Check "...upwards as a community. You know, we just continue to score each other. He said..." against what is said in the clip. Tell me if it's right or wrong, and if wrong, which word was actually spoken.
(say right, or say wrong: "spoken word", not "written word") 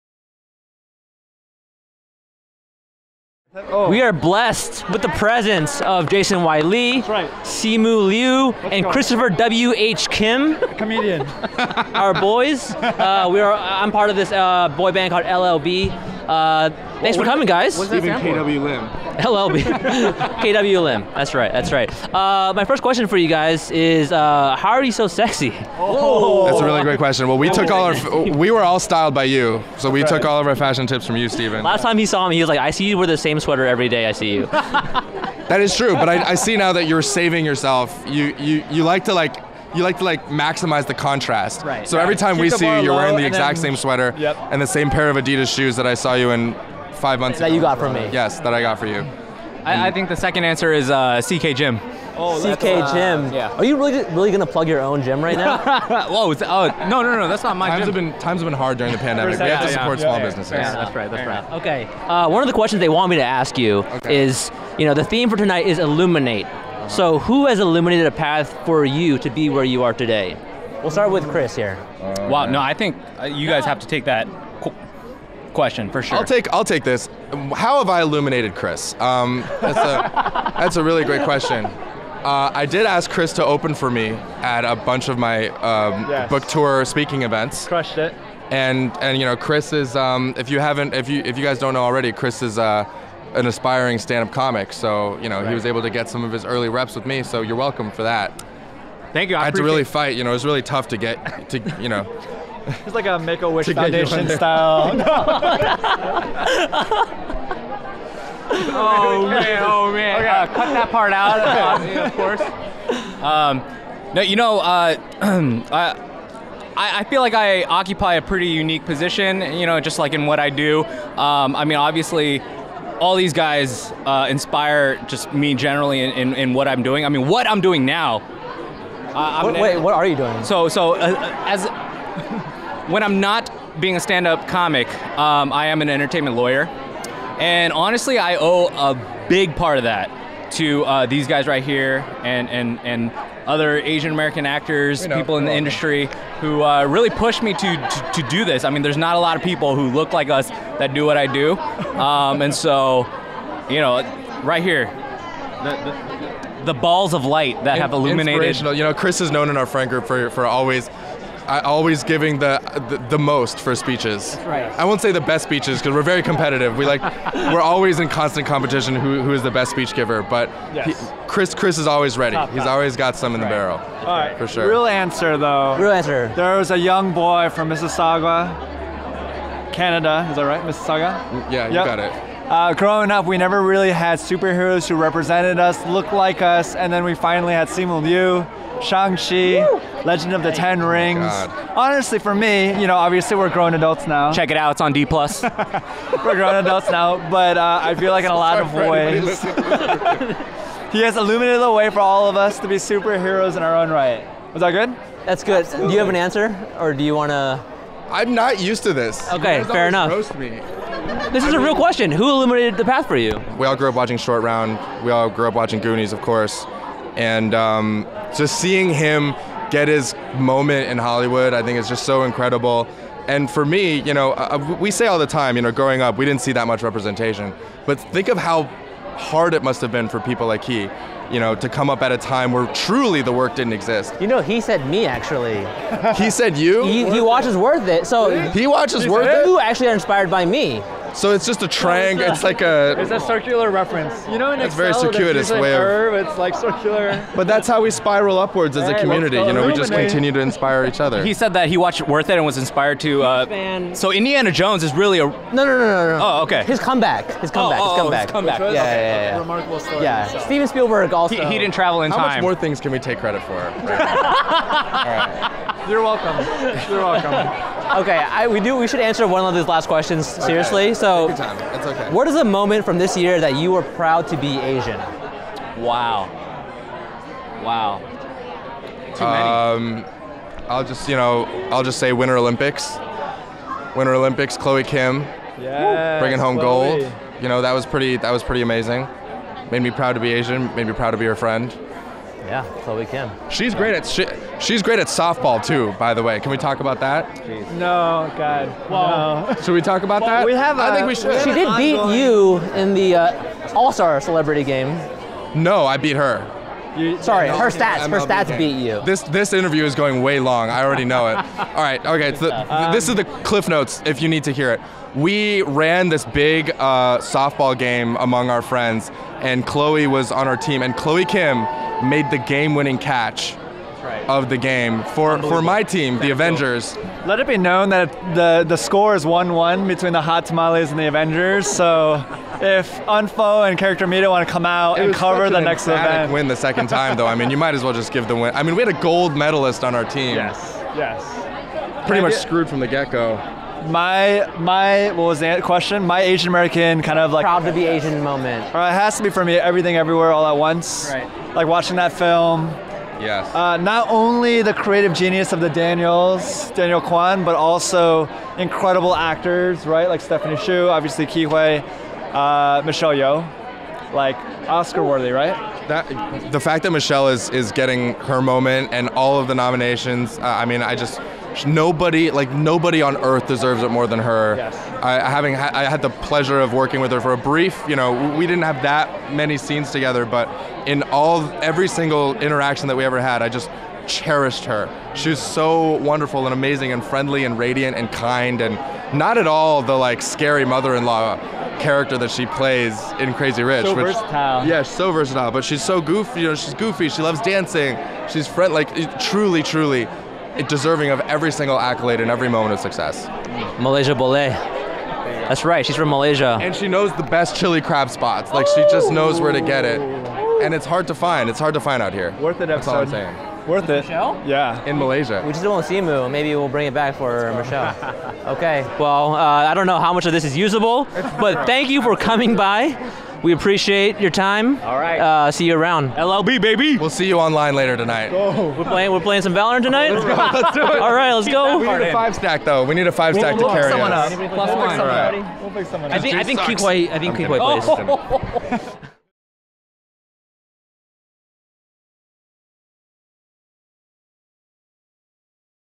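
wrong: "inspire", not "score".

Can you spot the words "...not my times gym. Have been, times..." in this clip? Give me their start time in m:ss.
0:57.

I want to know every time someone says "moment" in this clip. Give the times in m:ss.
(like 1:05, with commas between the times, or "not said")
3:40, 4:32, 5:48, 6:08, 6:42.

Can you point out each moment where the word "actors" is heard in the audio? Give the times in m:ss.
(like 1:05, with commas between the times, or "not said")
2:24, 5:59.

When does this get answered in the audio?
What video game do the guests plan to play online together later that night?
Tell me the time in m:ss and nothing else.
7:09.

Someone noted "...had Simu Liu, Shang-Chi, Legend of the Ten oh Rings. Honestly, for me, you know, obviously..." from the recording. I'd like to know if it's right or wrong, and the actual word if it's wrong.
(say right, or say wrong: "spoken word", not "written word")
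right.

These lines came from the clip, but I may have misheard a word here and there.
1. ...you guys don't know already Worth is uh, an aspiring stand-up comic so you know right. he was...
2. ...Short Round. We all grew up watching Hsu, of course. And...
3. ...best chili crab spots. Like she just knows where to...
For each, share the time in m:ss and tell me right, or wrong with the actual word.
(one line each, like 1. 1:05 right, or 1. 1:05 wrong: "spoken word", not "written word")
1. 1:31 wrong: "Chris", not "Worth"
2. 3:34 wrong: "Goonies", not "Hsu"
3. 6:47 right.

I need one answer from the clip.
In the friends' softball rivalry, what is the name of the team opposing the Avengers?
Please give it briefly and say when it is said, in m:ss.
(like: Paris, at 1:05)
Hot Tamales, at 5:30.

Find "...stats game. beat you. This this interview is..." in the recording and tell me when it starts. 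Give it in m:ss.
5:08.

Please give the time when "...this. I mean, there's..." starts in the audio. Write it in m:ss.
2:28.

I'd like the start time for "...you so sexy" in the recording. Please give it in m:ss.
0:24.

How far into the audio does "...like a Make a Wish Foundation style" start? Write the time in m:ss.
1:42.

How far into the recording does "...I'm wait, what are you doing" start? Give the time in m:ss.
2:09.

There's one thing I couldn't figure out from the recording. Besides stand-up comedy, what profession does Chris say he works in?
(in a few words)
Entertainment lawyer.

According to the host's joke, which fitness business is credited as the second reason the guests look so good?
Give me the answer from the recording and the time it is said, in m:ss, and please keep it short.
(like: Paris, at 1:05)
CK Gym, at 0:51.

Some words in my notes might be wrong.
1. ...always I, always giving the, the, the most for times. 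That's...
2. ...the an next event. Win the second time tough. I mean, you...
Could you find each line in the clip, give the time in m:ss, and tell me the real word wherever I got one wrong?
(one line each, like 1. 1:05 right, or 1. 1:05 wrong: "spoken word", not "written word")
1. 2:40 wrong: "speeches", not "times"
2. 5:35 wrong: "though", not "tough".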